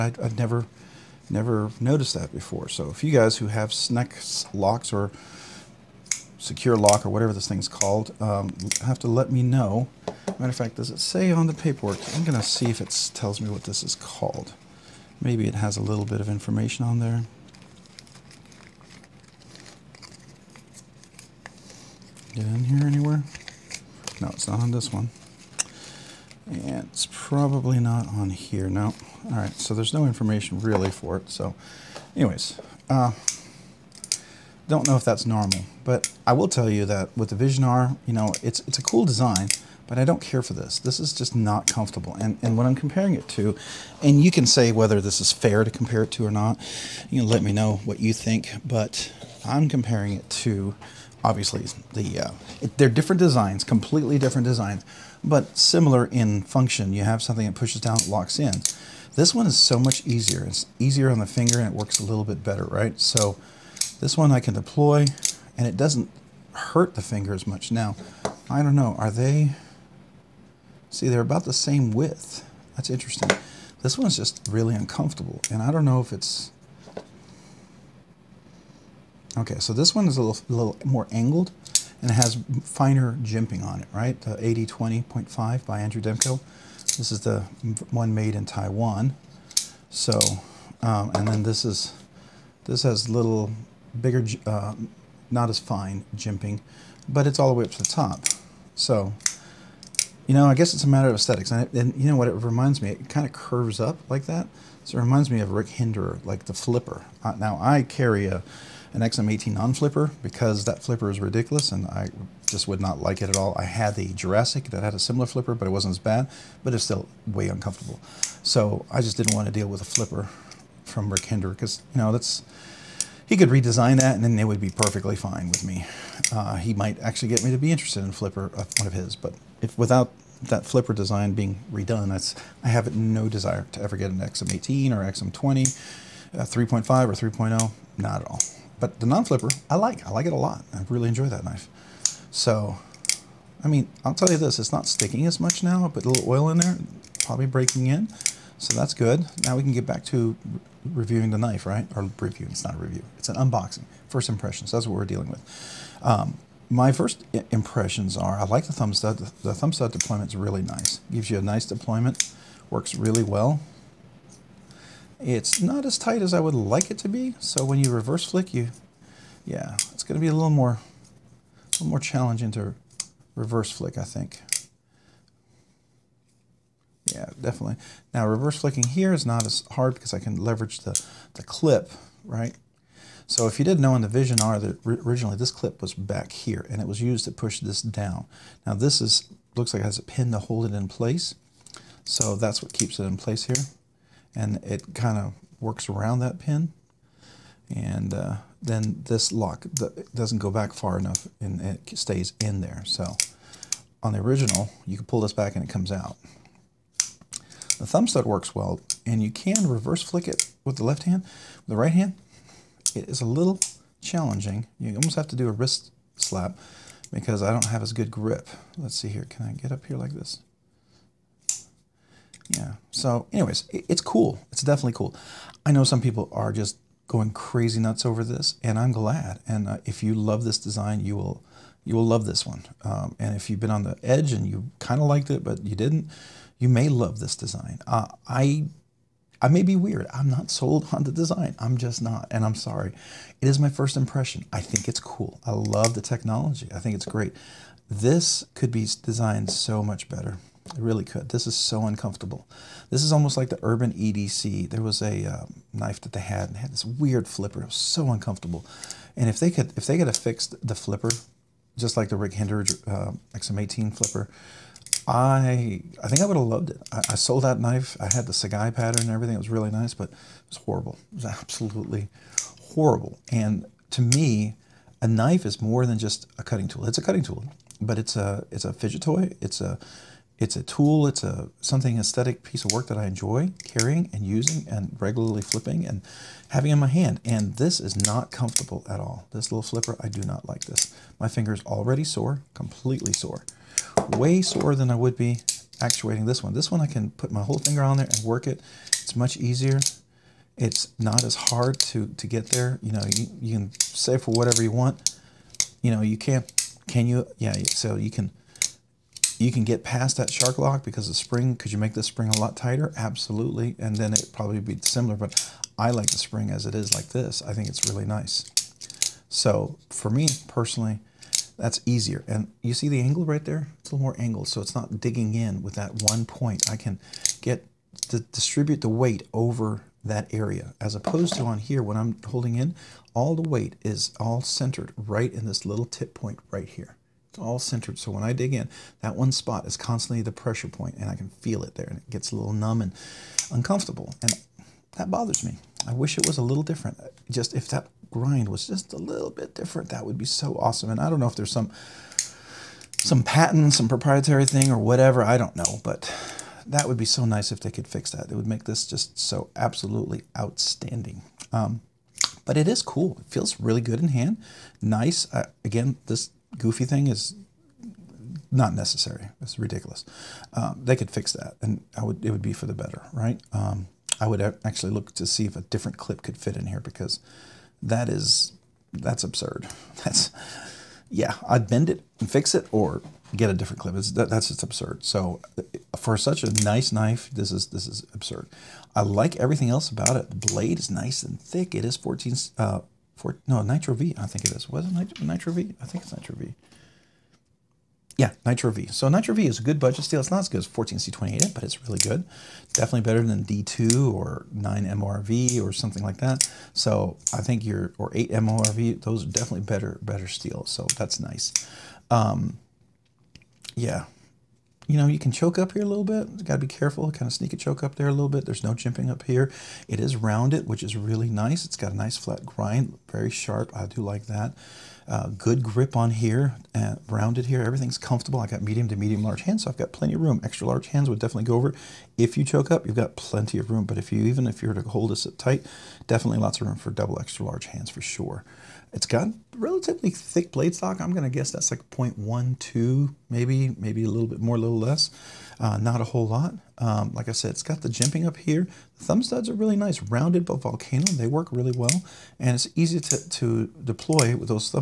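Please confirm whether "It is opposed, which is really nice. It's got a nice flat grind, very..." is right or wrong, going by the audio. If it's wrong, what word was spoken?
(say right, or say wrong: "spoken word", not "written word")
wrong: "rounded", not "opposed".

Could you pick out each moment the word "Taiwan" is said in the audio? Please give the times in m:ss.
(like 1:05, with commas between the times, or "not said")
1:28.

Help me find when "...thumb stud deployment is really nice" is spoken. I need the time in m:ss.
2:39.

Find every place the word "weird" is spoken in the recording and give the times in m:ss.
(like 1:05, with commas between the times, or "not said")
3:59, 4:16.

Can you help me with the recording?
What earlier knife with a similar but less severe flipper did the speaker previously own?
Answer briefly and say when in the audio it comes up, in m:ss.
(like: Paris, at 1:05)
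Jurassic, at 1:54.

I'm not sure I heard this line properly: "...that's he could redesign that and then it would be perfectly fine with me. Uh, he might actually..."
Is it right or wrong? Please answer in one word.
right.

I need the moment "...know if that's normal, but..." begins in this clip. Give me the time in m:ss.
0:34.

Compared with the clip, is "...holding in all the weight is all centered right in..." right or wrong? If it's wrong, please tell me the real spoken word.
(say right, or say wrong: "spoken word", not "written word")
right.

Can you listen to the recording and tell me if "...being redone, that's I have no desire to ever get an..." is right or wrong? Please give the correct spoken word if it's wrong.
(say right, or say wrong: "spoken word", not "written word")
right.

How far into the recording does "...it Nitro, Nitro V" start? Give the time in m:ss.
6:34.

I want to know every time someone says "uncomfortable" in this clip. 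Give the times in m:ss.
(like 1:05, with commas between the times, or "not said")
1:14, 1:57, 4:11, 4:18, 5:43.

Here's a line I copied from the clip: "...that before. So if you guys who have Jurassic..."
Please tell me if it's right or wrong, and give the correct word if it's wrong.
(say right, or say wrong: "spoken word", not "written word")
wrong: "Snecx", not "Jurassic".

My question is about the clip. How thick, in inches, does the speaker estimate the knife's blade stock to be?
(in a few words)
0.12.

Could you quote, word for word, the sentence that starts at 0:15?
Maybe it has a little bit of information on there.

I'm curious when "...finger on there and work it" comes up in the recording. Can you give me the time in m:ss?
4:57.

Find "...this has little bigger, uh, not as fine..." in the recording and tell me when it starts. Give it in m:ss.
1:32.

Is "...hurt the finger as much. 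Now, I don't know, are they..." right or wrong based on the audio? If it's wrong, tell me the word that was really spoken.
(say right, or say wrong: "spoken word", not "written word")
right.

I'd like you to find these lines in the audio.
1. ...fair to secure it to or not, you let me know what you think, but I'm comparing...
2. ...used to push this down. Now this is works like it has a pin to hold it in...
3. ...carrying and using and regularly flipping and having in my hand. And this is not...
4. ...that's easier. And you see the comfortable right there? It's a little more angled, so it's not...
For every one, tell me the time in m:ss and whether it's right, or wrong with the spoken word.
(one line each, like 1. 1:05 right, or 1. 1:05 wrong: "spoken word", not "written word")
1. 0:45 wrong: "compare", not "secure"
2. 3:07 wrong: "looks", not "works"
3. 4:43 right
4. 5:21 wrong: "angle", not "comfortable".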